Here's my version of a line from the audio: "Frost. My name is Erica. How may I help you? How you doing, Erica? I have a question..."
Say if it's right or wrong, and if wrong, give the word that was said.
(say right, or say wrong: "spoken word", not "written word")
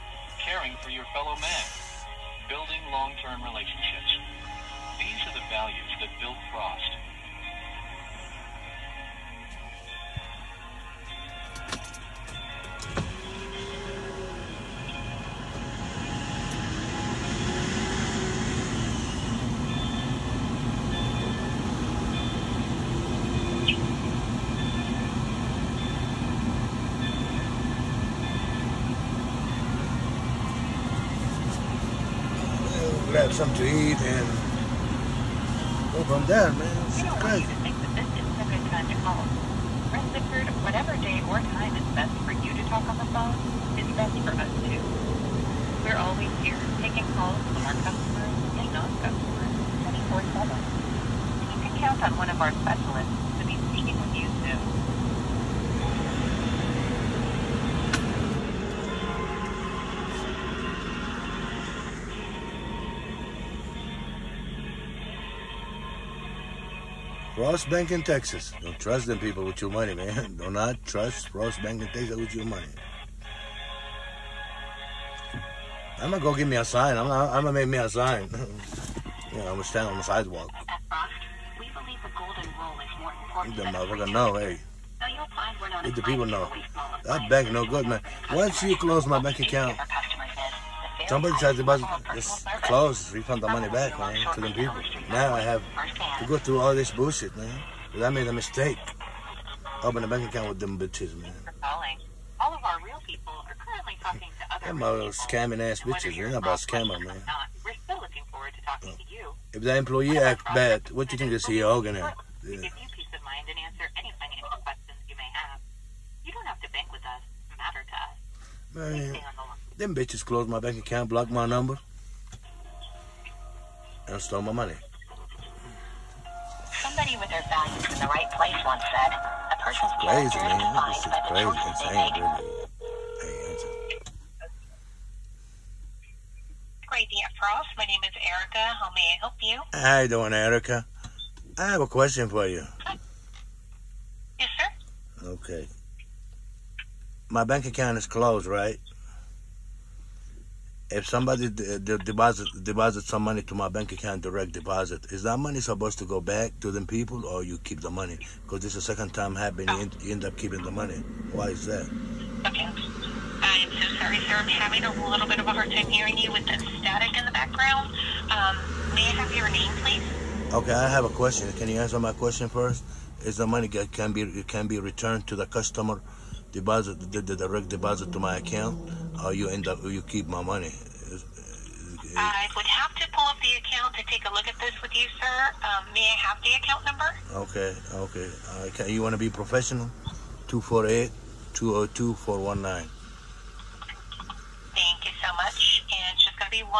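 right.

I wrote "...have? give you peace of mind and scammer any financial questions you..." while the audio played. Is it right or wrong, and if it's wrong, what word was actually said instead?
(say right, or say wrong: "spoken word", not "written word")
wrong: "answer", not "scammer".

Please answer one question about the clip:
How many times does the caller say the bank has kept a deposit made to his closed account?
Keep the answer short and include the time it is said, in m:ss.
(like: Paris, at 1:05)
Second time, at 2:38.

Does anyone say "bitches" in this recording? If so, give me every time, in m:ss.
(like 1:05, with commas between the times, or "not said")
1:40, 1:45, 1:59.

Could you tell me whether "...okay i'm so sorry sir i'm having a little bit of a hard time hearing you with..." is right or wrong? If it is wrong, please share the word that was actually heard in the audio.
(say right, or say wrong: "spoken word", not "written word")
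right.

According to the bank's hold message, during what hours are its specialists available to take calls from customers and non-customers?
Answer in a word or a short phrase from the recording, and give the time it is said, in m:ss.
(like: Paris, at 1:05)
24-7, at 0:50.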